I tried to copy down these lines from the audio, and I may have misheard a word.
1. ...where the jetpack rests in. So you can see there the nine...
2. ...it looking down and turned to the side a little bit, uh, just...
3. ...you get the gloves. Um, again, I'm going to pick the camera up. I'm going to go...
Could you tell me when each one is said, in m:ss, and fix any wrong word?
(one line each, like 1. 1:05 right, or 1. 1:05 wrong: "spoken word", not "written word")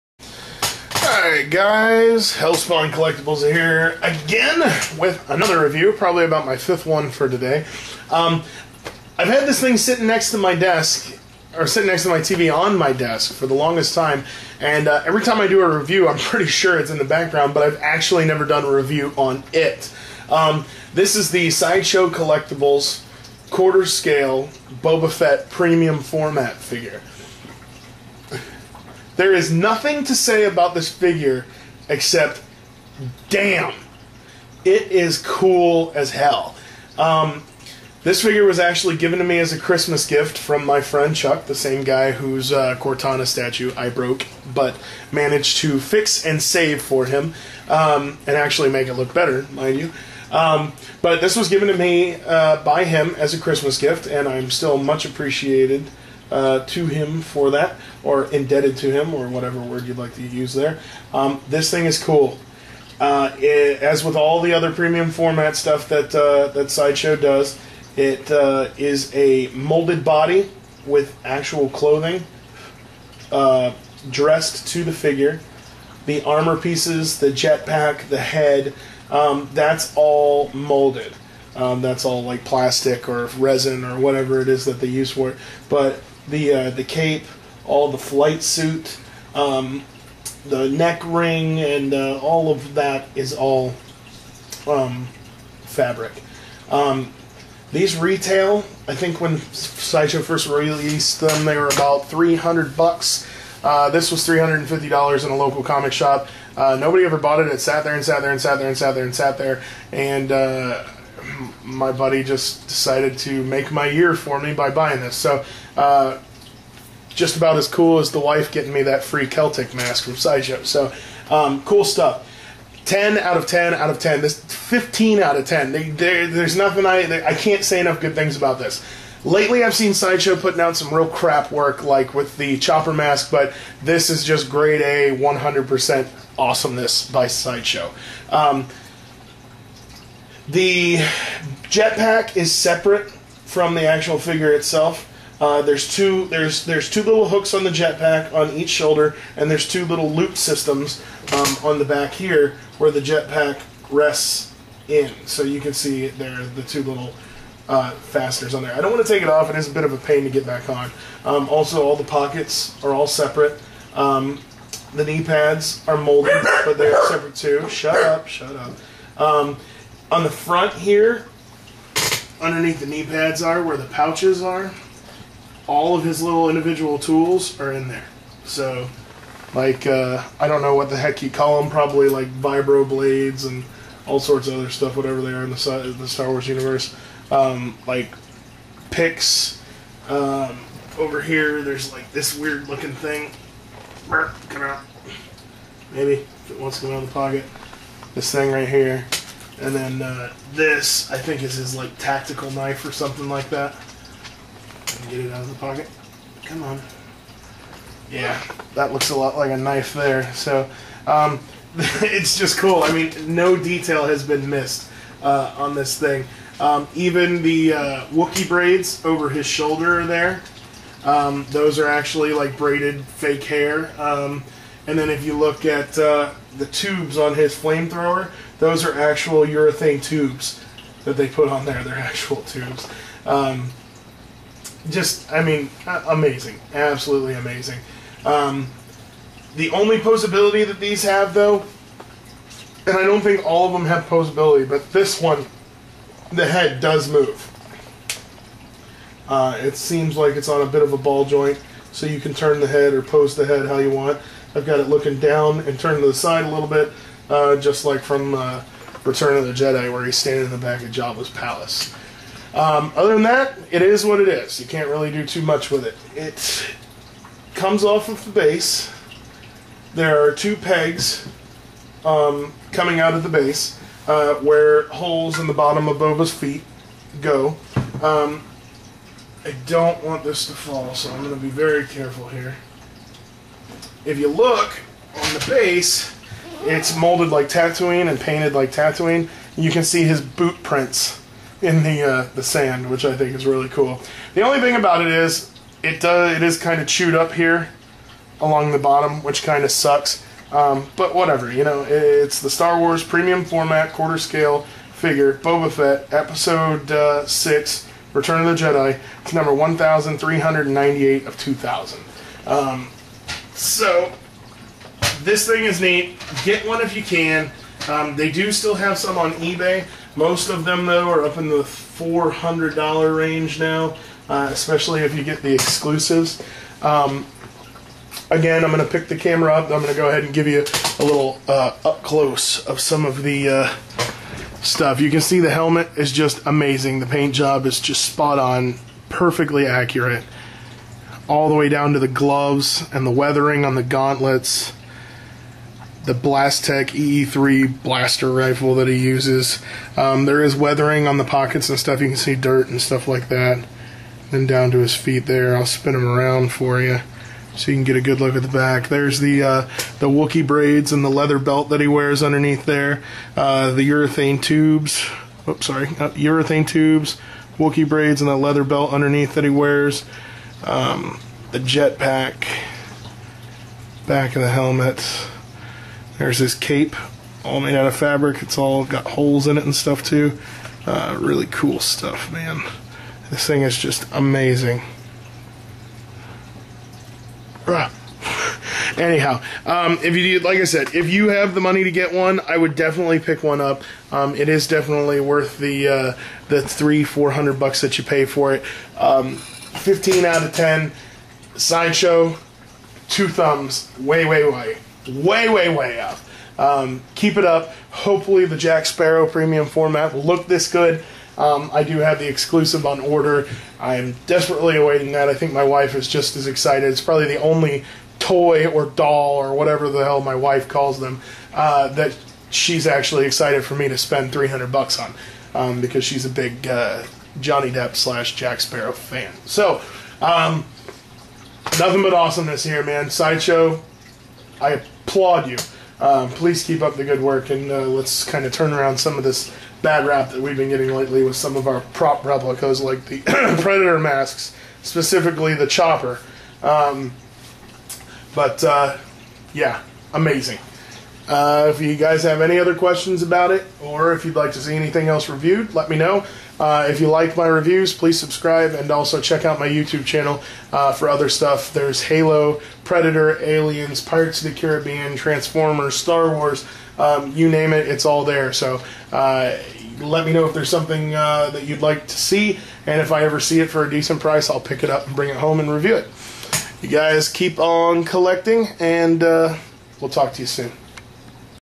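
1. 2:32 wrong: "two", not "nine"
2. 4:14 right
3. 5:25 wrong: "exclusives", not "gloves".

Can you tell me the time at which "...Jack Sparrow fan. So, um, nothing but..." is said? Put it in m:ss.
7:08.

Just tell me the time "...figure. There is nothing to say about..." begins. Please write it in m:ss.
0:26.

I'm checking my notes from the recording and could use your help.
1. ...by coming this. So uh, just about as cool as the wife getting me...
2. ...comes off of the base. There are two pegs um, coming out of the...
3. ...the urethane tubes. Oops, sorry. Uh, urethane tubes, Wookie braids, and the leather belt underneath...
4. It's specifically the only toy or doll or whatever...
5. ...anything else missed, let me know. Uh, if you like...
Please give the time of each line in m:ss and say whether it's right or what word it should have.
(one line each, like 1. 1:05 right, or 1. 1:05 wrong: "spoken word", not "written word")
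1. 1:54 wrong: "buying", not "coming"
2. 4:27 right
3. 6:03 right
4. 6:56 wrong: "probably", not "specifically"
5. 7:34 wrong: "reviewed", not "missed".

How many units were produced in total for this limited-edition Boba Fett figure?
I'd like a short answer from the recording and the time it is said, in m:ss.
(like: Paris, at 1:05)
2000, at 5:11.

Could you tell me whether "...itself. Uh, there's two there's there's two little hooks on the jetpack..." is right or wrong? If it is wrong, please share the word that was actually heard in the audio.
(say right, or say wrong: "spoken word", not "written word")
right.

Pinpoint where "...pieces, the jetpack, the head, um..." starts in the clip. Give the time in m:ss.
1:16.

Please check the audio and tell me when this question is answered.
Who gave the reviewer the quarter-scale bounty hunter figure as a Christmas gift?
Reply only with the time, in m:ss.
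0:41.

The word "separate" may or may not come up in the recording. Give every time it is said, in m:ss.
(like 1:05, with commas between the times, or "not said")
2:22, 2:43, 2:47.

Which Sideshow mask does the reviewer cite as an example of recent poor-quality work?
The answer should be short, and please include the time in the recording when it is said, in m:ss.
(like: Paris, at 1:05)
The chopper mask, at 2:12.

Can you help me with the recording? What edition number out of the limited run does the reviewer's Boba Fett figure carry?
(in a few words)
1398.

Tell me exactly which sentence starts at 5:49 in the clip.
Um, there is weathering on the pockets and stuff.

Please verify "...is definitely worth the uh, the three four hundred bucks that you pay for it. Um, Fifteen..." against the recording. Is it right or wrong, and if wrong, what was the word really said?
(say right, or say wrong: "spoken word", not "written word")
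right.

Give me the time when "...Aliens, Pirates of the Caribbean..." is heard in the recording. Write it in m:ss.
7:43.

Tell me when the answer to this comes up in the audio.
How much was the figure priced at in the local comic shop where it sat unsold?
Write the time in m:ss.
1:44.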